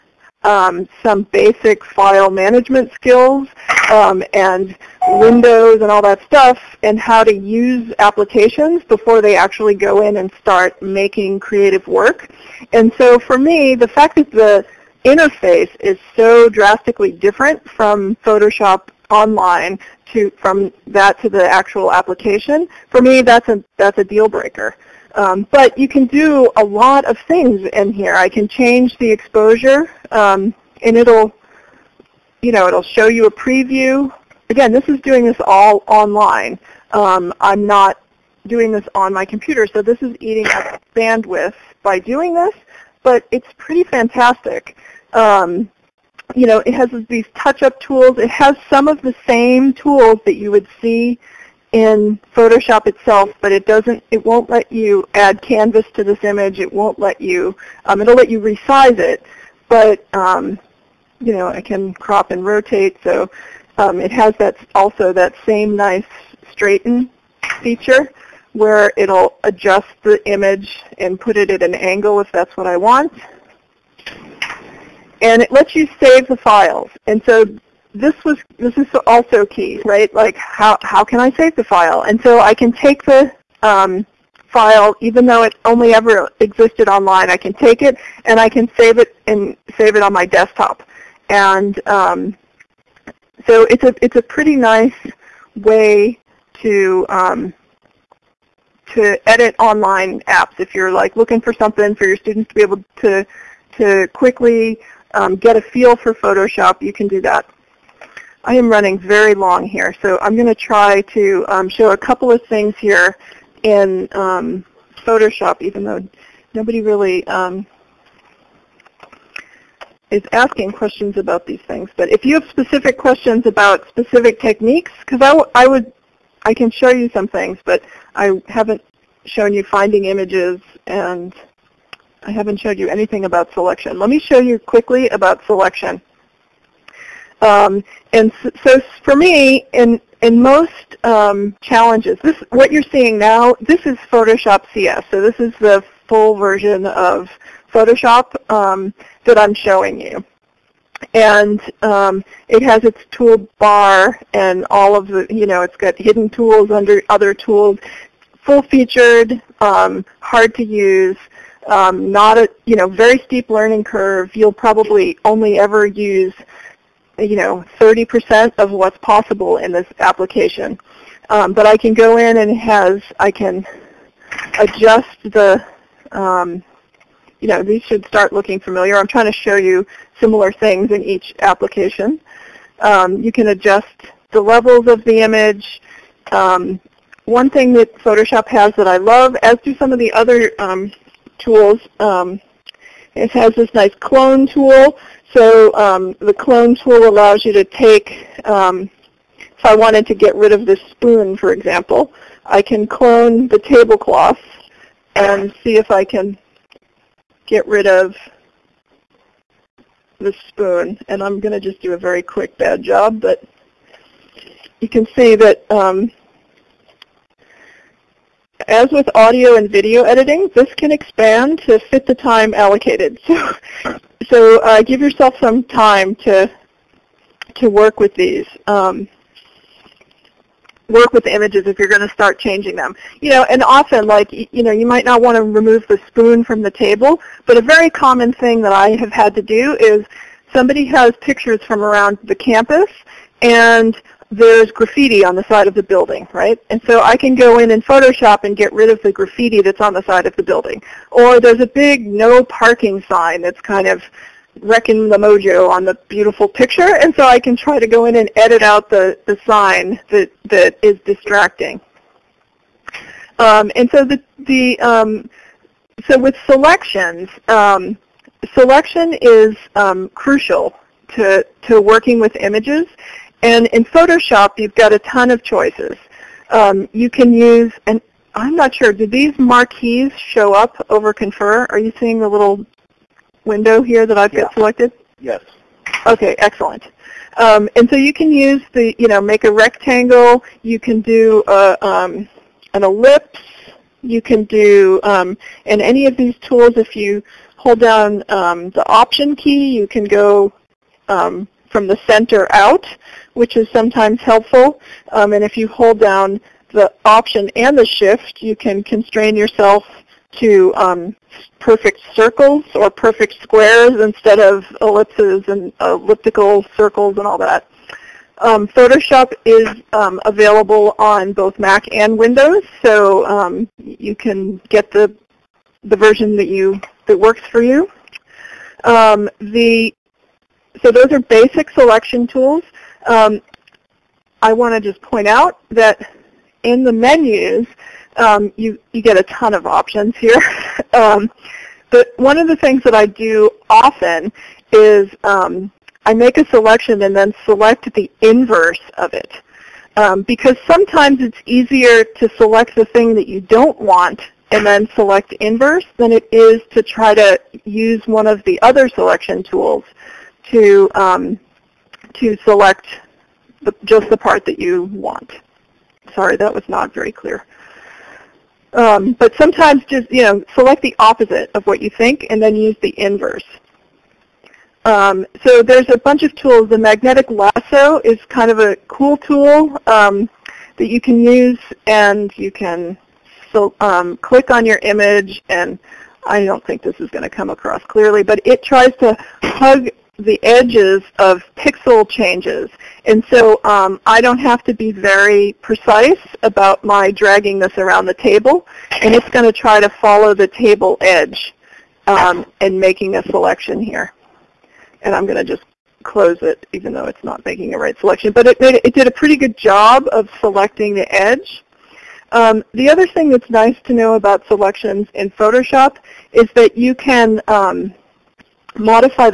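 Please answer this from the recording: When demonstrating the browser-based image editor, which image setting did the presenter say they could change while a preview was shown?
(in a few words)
Exposure.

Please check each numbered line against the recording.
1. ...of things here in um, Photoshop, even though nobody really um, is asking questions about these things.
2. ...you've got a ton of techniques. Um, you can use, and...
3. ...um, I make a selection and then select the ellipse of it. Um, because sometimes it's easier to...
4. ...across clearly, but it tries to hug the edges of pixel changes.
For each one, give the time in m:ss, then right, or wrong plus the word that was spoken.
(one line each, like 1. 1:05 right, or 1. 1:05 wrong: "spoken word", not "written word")
1. 1:52 right
2. 4:34 wrong: "choices", not "techniques"
3. 5:45 wrong: "inverse", not "ellipse"
4. 6:27 right.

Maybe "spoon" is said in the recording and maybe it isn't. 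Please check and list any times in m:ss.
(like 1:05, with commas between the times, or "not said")
3:20, 3:30, 3:56.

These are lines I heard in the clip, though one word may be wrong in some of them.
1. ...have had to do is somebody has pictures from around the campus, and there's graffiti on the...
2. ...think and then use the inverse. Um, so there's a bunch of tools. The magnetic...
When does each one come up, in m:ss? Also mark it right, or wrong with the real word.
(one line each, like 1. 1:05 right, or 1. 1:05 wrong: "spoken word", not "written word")
1. 3:58 right
2. 6:11 right.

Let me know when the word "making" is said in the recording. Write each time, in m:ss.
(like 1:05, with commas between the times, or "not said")
0:10, 6:42, 6:47.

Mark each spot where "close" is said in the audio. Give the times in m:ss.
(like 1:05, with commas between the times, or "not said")
6:46.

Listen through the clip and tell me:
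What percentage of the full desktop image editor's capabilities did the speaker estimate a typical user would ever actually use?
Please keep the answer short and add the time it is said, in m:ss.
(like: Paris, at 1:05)
30%, at 2:47.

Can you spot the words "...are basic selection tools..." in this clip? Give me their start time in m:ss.
5:31.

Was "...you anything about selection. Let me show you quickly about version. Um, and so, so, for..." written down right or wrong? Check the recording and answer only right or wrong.
wrong.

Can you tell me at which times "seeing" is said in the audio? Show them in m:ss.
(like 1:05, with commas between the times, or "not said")
2:22, 4:41.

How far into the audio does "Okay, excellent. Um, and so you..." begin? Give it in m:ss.
4:46.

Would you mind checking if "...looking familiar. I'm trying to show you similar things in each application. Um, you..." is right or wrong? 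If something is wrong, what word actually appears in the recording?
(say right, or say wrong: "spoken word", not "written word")
right.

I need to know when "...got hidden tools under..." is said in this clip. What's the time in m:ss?
2:35.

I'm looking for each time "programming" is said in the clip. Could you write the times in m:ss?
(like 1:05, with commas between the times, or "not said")
not said.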